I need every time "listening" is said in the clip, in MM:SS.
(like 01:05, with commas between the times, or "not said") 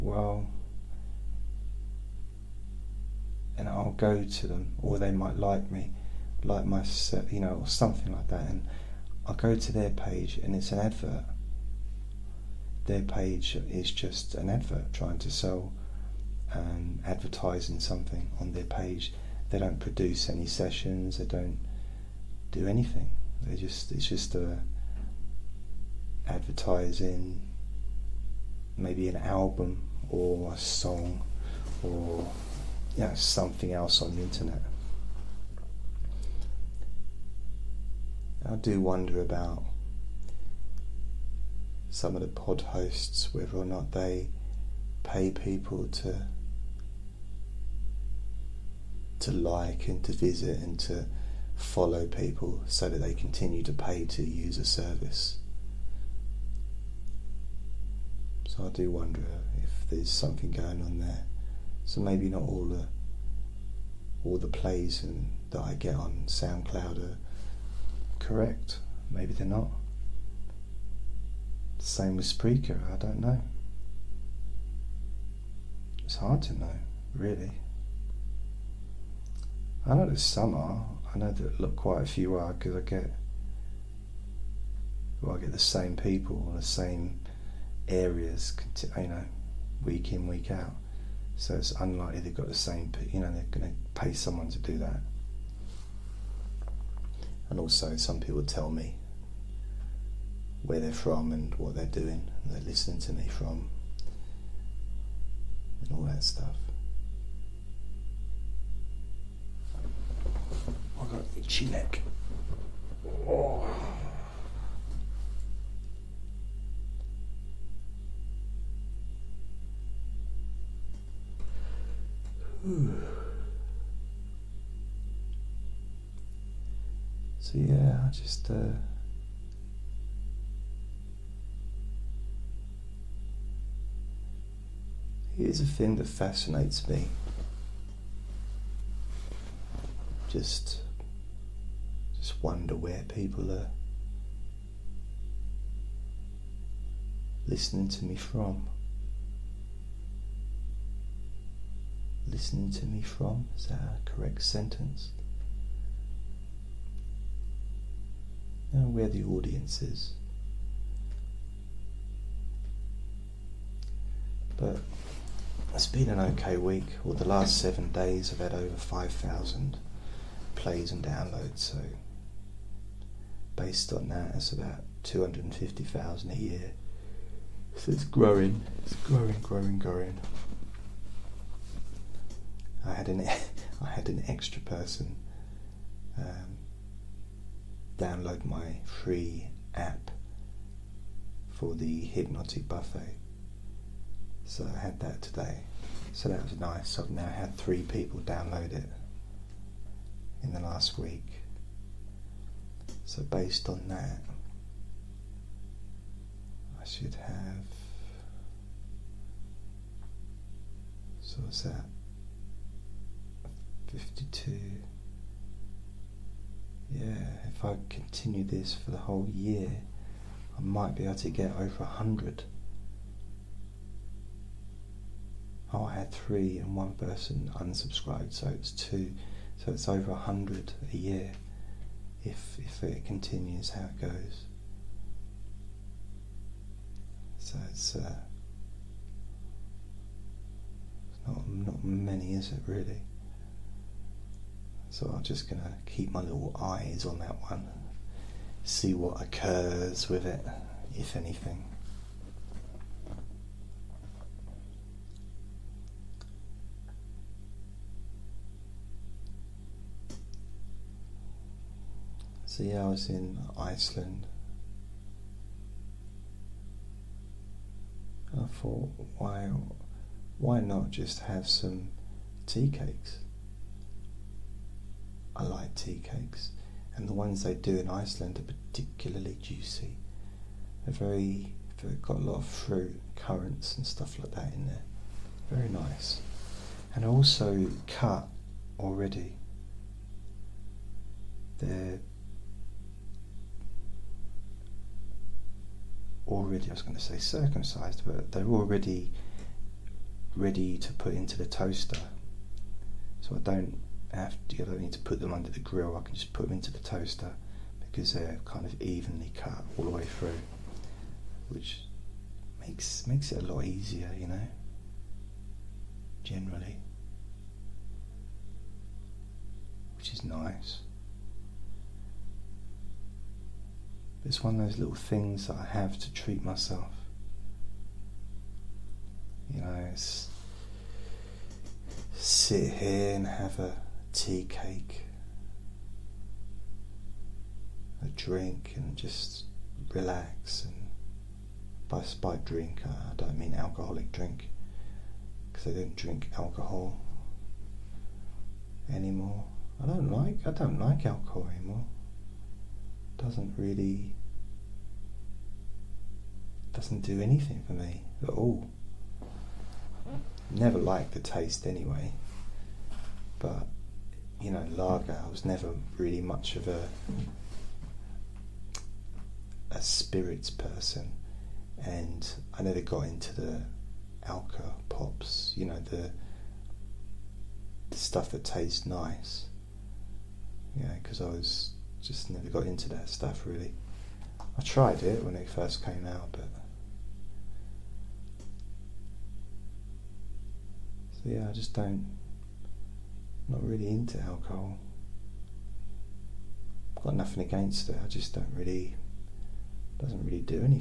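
01:42, 02:27, 02:32.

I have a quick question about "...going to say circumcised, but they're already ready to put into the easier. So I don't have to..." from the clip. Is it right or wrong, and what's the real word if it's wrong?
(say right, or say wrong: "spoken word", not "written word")
wrong: "toaster", not "easier".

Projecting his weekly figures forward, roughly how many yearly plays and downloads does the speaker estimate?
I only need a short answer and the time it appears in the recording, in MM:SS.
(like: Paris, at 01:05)
250,000, at 02:55.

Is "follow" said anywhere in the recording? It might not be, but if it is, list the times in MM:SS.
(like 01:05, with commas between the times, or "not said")
00:51.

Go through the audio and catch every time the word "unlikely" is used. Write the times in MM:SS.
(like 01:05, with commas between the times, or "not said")
01:31.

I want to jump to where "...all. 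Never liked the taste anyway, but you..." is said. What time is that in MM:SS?
05:58.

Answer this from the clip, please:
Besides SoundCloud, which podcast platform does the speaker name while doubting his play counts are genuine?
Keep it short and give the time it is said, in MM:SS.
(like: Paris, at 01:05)
Spreaker, at 01:12.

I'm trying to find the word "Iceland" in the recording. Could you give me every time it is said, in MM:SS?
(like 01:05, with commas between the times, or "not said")
04:23, 04:37.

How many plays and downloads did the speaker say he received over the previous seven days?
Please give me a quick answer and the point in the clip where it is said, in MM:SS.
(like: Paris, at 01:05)
over 5,000, at 02:48.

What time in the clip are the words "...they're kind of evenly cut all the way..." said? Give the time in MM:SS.
05:08.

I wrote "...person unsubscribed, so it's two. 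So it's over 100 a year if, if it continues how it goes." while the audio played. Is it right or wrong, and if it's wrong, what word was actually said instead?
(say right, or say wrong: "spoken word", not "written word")
right.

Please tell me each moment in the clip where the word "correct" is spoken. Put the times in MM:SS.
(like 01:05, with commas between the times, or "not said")
01:08, 02:34.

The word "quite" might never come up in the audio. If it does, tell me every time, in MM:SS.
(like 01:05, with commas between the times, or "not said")
01:21.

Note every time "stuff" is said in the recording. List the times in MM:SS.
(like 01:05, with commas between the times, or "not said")
01:46, 04:43, 06:17, 06:23.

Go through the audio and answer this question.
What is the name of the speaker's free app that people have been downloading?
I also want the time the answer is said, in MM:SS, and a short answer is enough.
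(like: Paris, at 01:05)
the hypnotic buffet, at 03:12.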